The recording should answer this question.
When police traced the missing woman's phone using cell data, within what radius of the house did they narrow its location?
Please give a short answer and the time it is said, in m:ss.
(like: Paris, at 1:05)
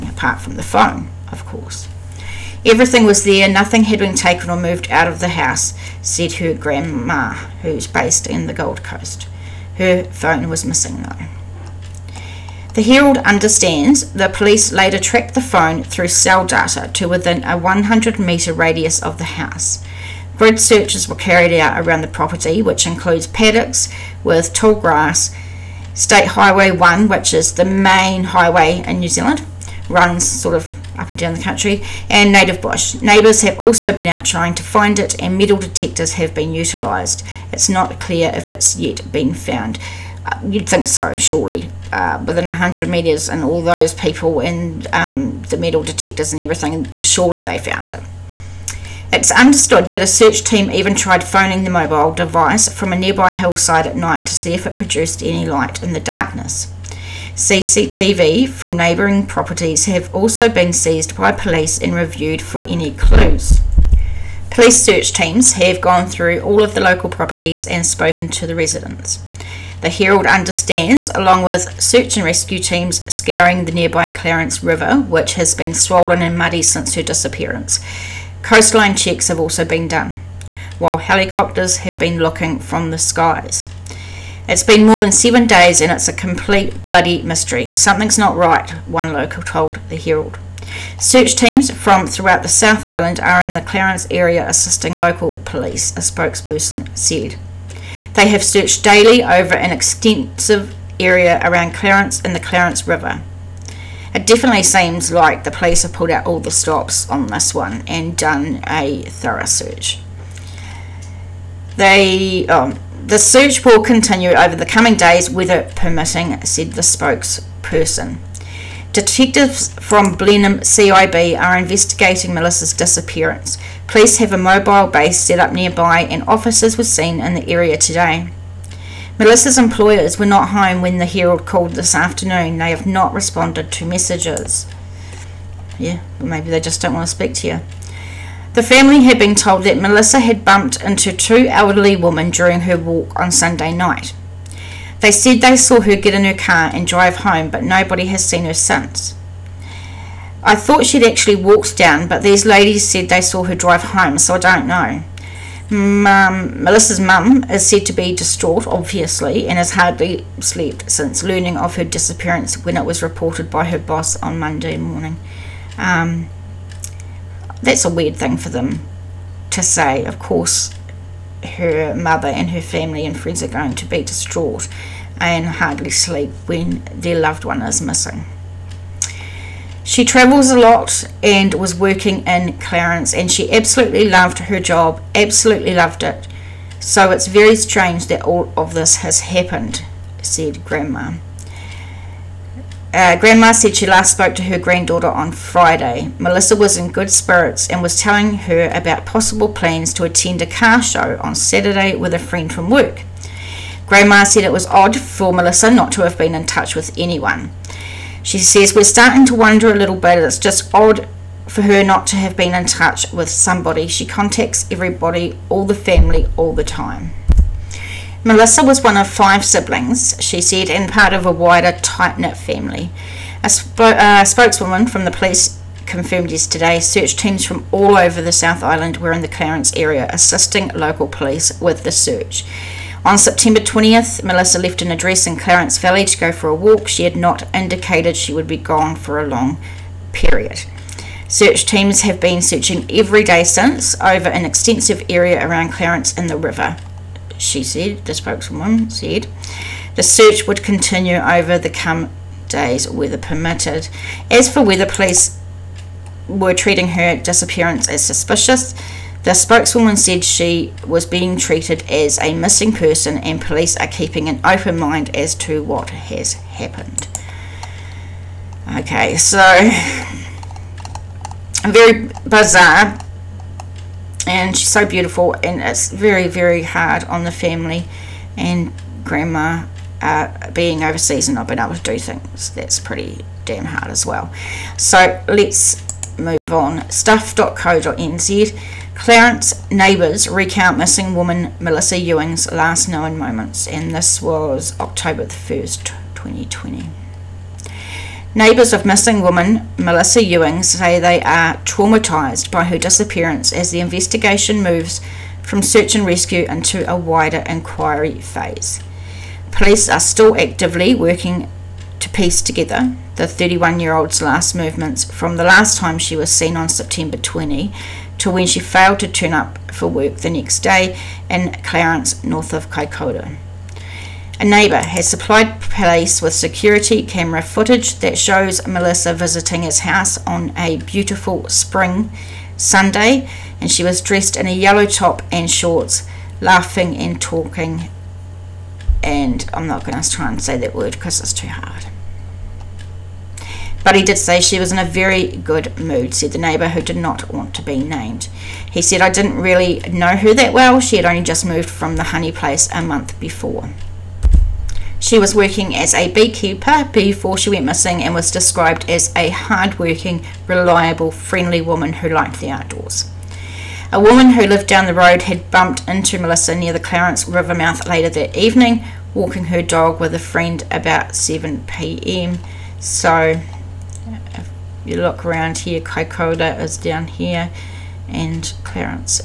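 100 metres, at 0:17.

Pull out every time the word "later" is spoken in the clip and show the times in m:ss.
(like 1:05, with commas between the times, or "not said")
0:14, 6:07.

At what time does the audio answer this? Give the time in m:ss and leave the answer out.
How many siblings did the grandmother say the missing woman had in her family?
3:39.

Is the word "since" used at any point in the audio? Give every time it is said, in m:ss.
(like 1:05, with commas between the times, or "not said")
1:16, 2:28, 2:40, 4:03.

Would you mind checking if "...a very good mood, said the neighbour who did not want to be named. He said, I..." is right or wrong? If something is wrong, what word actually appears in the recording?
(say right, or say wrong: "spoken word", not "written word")
right.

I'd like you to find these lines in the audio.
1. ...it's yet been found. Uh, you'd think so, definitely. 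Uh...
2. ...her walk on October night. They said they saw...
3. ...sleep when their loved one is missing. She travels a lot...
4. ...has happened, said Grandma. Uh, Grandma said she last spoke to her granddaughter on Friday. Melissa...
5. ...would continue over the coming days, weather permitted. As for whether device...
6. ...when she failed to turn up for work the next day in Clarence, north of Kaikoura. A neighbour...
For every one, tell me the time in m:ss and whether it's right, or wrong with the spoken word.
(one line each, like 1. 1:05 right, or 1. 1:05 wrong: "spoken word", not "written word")
1. 0:38 wrong: "surely", not "definitely"
2. 2:22 wrong: "Sunday", not "October"
3. 2:55 right
4. 3:08 right
5. 4:10 wrong: "police", not "device"
6. 5:18 right.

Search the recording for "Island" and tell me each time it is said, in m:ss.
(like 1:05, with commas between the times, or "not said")
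1:32, 3:48.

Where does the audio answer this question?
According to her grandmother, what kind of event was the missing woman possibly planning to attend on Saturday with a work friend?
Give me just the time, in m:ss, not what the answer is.
3:20.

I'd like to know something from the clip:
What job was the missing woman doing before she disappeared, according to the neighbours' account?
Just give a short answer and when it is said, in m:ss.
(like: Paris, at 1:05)
Beekeeper, at 5:56.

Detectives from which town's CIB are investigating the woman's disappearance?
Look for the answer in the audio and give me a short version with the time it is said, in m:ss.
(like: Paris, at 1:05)
Blenheim, at 2:00.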